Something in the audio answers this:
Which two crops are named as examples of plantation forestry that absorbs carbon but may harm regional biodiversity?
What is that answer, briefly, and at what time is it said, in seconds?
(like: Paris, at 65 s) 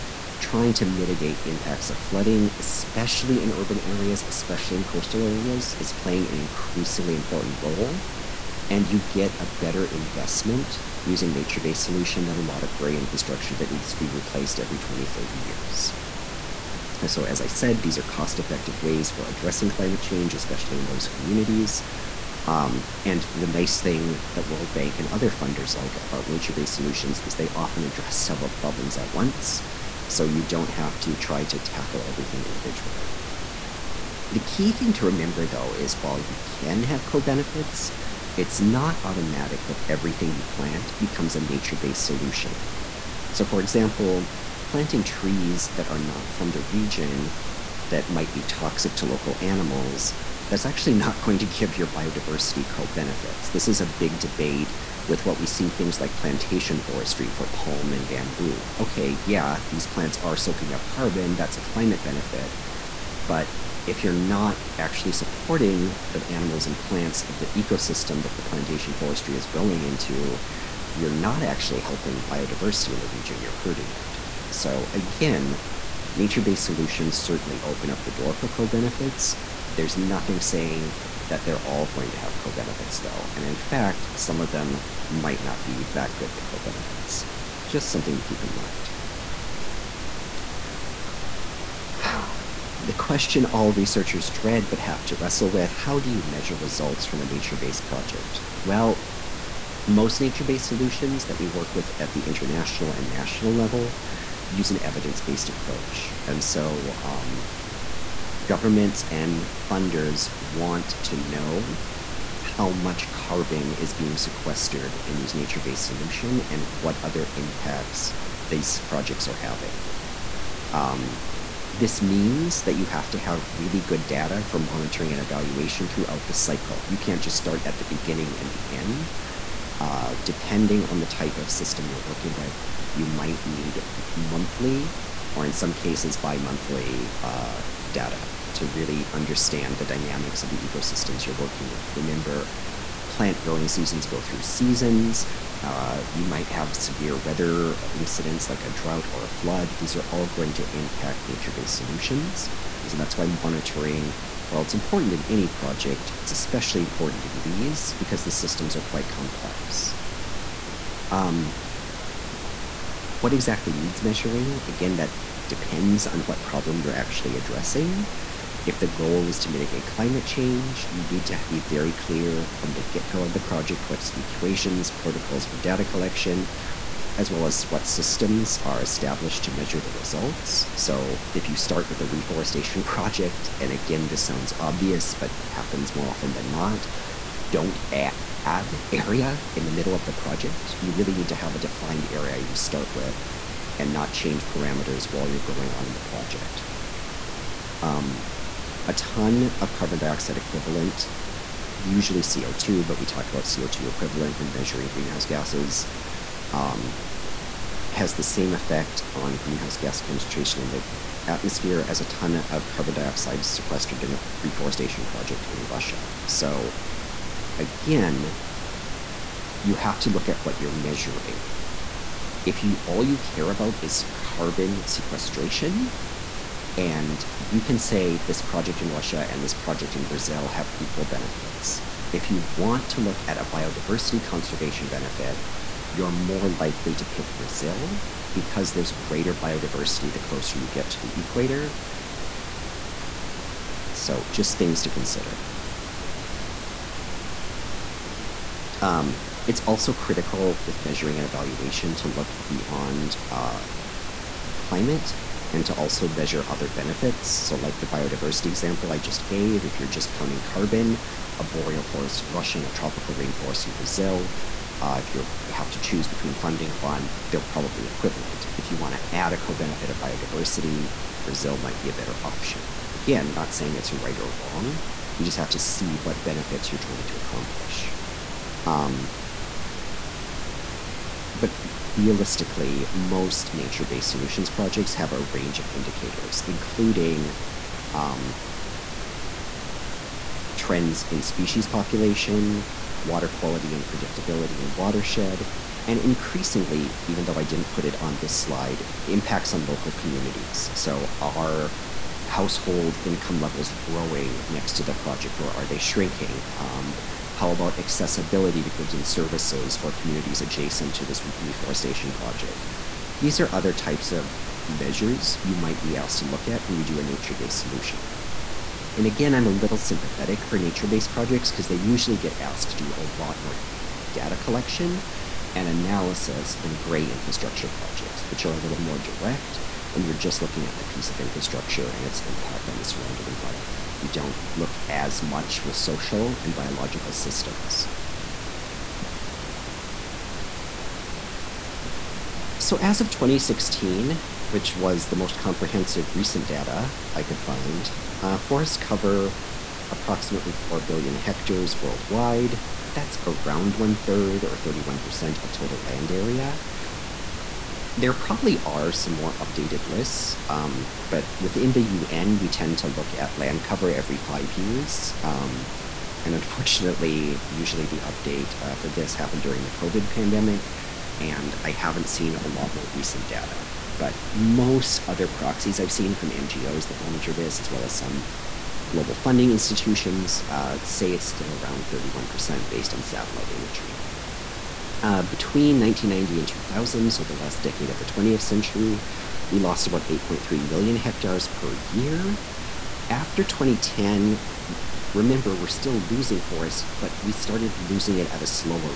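palm and bamboo, at 57 s.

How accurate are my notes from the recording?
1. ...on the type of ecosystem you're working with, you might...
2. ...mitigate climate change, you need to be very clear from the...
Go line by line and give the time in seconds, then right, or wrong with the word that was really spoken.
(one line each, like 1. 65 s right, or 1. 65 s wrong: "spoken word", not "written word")
1. 130 s wrong: "system", not "ecosystem"
2. 169 s right.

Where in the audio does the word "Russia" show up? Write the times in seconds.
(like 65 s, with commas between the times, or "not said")
215 s, 228 s, 262 s.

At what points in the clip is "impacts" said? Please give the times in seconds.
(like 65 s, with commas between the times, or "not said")
1 s, 117 s, 150 s, 299 s, 332 s.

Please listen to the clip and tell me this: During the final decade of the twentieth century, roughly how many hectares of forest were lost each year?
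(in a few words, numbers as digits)
8.3 million hectares.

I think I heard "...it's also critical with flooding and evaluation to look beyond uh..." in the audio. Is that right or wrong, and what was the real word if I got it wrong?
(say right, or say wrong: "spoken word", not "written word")
wrong: "measuring", not "flooding".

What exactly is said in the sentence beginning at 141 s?
Remember, plant growing seasons go through seasons.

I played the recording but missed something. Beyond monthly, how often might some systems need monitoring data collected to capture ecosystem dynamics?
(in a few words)
bi-monthly.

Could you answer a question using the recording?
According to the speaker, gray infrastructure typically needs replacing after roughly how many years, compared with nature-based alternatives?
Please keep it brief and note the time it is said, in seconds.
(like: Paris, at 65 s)
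20, 30 years, at 14 s.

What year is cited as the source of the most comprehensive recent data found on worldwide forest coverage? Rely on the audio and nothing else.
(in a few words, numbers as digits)
2016.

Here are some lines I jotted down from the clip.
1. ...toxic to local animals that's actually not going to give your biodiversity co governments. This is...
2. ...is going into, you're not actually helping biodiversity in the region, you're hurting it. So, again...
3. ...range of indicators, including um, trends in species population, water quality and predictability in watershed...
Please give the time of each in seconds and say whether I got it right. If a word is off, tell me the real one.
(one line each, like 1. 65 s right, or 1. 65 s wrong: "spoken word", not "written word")
1. 48 s wrong: "benefits", not "governments"
2. 69 s right
3. 285 s right.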